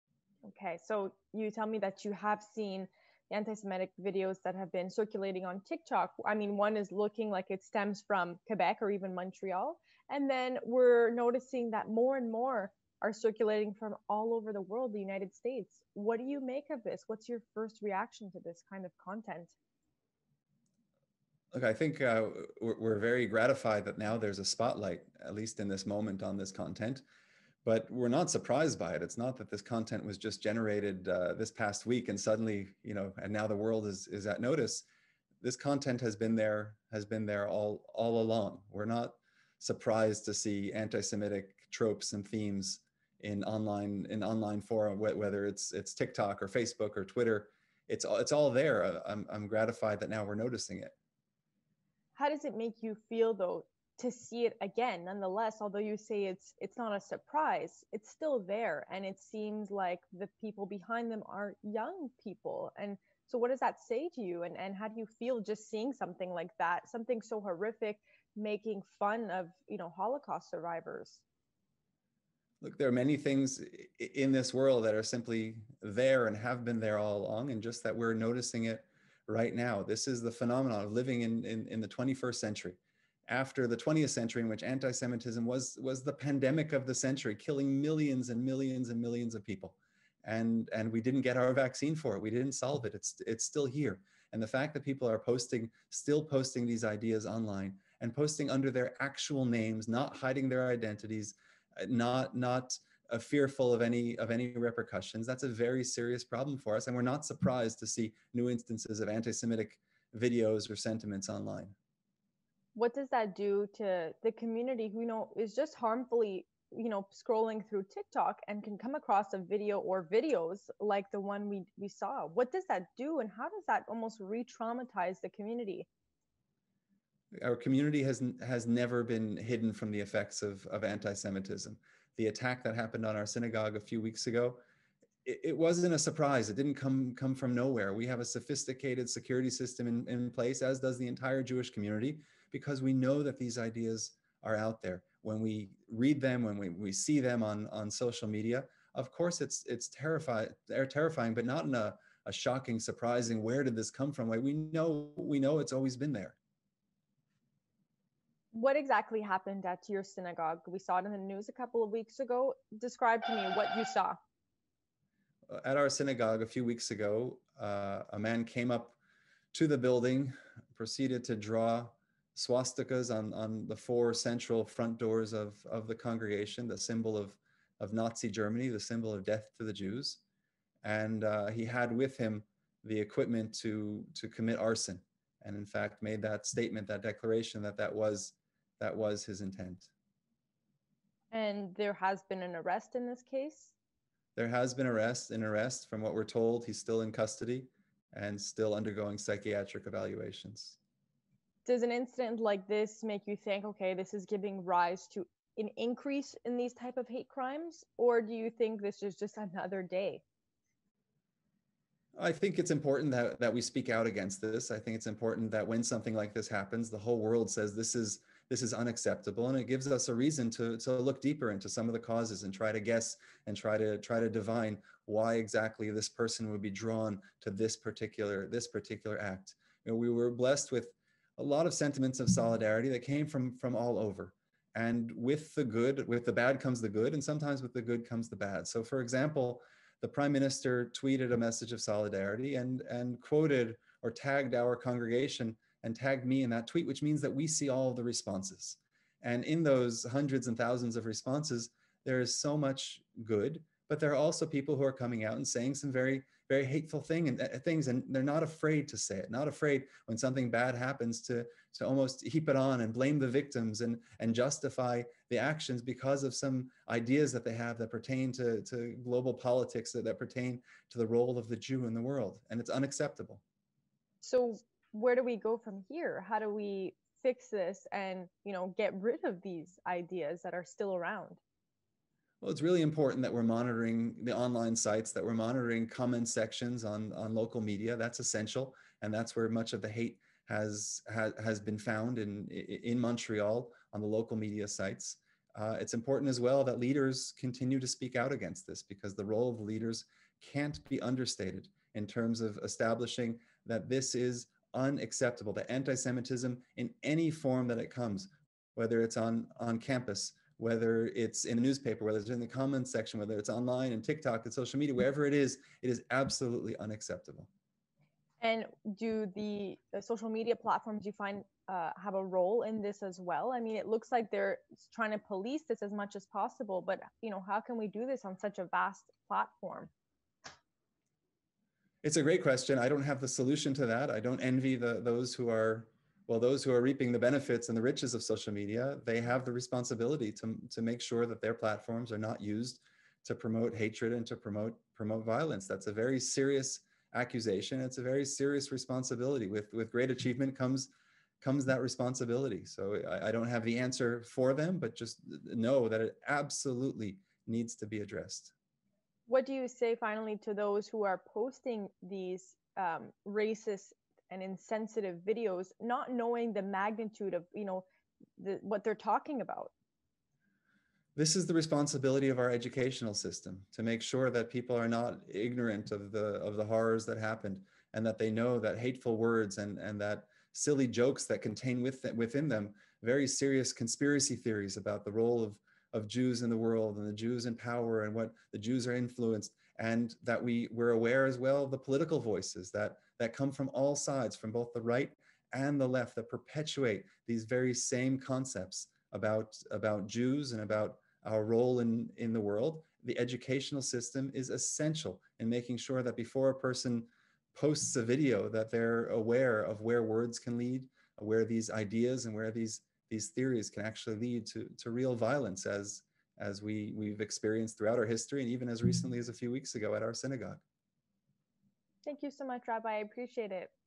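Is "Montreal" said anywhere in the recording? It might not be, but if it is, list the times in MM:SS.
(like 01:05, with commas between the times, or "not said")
00:09, 04:52.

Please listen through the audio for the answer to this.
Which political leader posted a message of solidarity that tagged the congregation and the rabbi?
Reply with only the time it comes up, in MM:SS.
04:00.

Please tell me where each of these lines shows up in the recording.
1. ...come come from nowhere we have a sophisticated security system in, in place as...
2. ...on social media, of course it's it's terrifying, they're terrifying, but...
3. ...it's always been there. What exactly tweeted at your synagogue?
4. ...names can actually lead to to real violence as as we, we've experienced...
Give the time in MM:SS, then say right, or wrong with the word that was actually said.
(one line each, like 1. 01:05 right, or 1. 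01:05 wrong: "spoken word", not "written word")
1. 02:16 right
2. 02:27 right
3. 02:35 wrong: "happened", not "tweeted"
4. 06:53 wrong: "theories", not "names".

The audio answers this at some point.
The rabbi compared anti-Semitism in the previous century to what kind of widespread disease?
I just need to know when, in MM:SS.
01:26.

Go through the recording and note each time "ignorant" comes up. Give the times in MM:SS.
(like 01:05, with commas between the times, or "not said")
06:15.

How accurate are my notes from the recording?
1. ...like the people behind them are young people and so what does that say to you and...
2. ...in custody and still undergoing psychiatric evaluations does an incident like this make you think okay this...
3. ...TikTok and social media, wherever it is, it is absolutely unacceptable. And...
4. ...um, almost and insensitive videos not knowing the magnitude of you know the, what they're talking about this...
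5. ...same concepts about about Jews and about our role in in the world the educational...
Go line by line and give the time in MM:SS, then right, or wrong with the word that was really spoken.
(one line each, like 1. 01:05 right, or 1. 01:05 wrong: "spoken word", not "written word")
1. 00:59 right
2. 03:17 right
3. 05:14 right
4. 06:02 wrong: "racist", not "almost"
5. 06:37 right.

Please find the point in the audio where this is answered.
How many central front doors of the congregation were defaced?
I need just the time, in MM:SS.
02:53.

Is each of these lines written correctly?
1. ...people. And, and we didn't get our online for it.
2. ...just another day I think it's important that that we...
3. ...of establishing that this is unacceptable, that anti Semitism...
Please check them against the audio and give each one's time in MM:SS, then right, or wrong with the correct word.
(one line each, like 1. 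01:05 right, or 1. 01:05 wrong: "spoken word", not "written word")
1. 01:29 wrong: "vaccine", not "online"
2. 03:29 right
3. 05:02 right.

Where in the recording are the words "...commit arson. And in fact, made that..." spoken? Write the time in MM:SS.
03:04.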